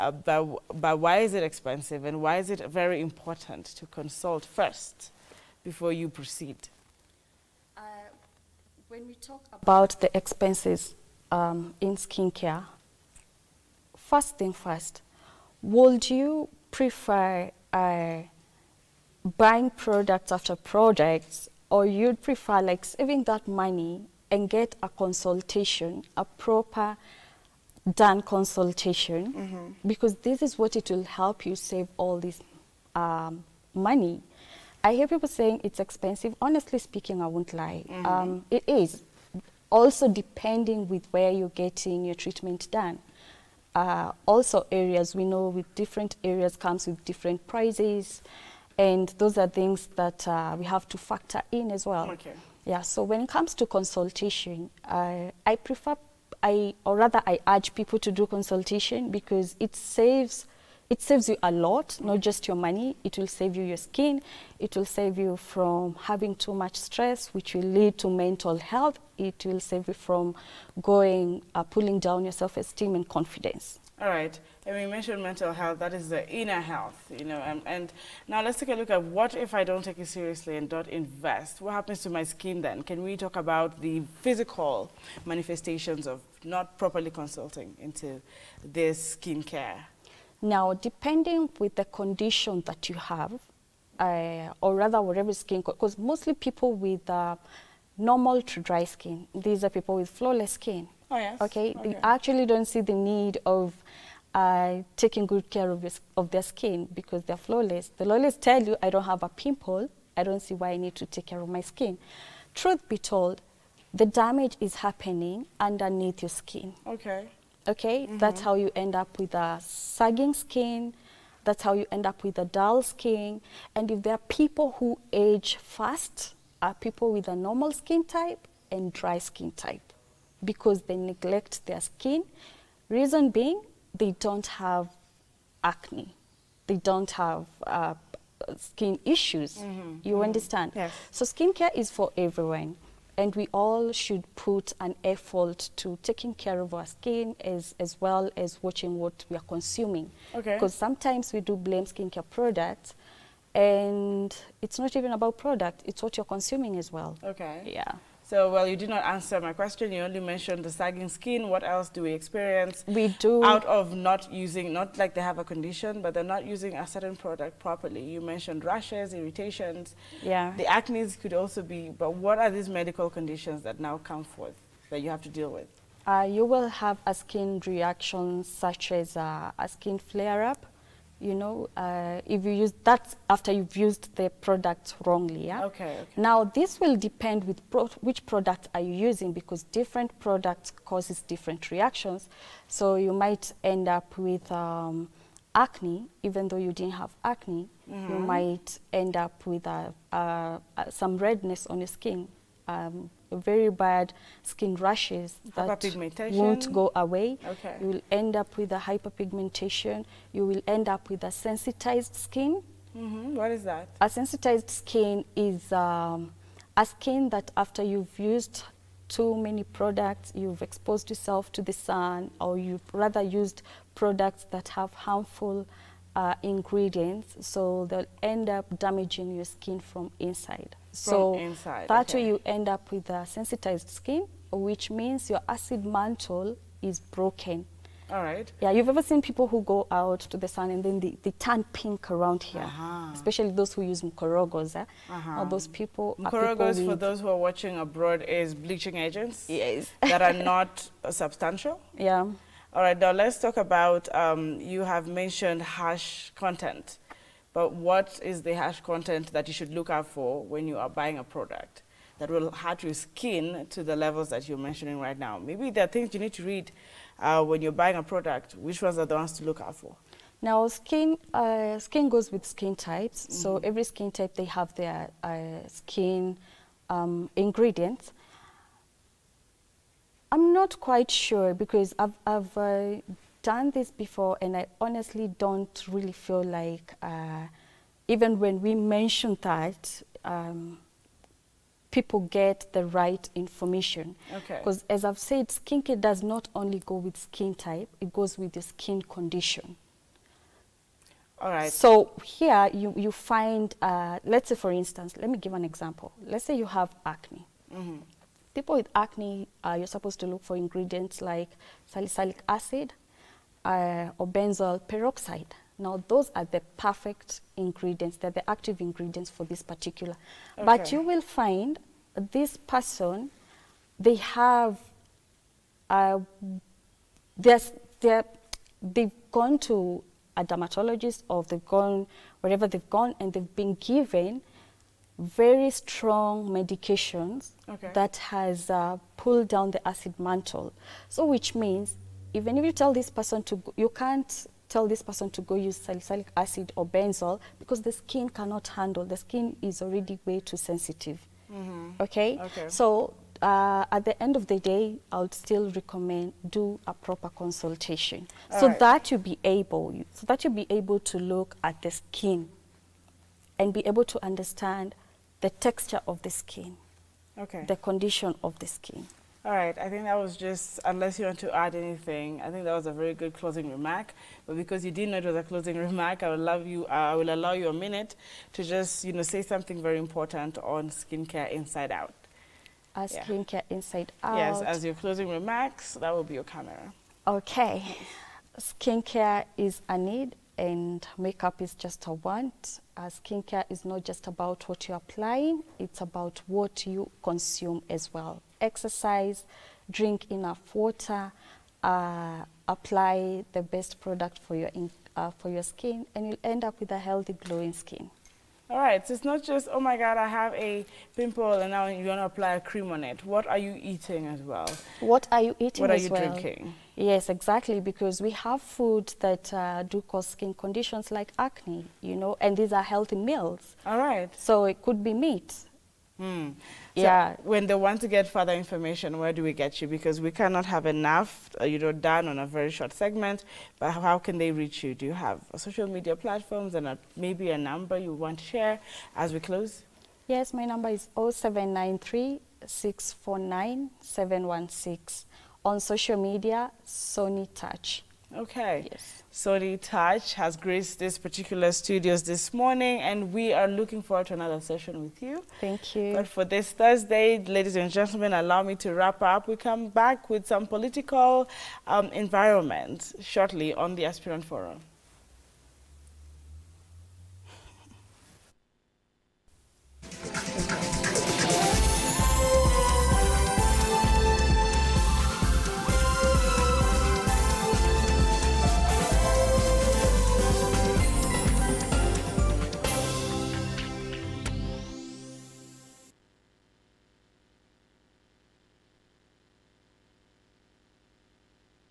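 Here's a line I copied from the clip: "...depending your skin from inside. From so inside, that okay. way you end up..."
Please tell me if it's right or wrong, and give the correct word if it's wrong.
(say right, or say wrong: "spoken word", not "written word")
wrong: "damaging", not "depending".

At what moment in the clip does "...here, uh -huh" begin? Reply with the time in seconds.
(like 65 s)
242 s.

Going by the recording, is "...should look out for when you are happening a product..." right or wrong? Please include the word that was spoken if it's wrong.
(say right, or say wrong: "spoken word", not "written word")
wrong: "buying", not "happening".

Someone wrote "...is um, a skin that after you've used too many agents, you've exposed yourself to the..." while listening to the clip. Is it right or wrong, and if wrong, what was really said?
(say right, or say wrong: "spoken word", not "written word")
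wrong: "products", not "agents".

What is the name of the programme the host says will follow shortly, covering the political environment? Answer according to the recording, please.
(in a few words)
Aspirant Forum.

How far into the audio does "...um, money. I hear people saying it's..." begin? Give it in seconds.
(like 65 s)
32 s.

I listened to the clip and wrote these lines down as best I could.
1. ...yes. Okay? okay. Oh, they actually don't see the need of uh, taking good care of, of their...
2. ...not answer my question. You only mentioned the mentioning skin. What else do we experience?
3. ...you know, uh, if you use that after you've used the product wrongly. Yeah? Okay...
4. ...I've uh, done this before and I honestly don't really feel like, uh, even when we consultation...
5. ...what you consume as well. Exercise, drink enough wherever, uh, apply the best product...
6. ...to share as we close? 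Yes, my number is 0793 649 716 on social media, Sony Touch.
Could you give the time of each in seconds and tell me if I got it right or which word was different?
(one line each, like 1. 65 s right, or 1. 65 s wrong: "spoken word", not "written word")
1. 101 s right
2. 158 s wrong: "sagging", not "mentioning"
3. 181 s right
4. 282 s wrong: "mention", not "consultation"
5. 396 s wrong: "water", not "wherever"
6. 438 s right.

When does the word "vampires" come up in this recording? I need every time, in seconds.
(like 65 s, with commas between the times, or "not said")
not said.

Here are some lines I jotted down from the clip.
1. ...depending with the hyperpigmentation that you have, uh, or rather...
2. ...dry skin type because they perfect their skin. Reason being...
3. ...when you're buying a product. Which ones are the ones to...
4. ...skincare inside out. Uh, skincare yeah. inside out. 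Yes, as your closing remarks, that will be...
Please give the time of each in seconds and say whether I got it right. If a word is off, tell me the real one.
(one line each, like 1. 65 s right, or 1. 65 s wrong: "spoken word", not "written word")
1. 90 s wrong: "condition", not "hyperpigmentation"
2. 128 s wrong: "neglect", not "perfect"
3. 267 s right
4. 380 s right.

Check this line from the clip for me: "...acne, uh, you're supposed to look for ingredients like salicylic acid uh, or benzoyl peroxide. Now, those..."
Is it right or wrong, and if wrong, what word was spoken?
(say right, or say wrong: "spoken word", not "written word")
right.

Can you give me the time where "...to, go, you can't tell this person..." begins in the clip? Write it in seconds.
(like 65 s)
343 s.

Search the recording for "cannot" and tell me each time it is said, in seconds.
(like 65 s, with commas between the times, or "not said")
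348 s, 430 s.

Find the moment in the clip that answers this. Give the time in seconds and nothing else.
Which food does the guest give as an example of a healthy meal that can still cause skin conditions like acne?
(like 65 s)
425 s.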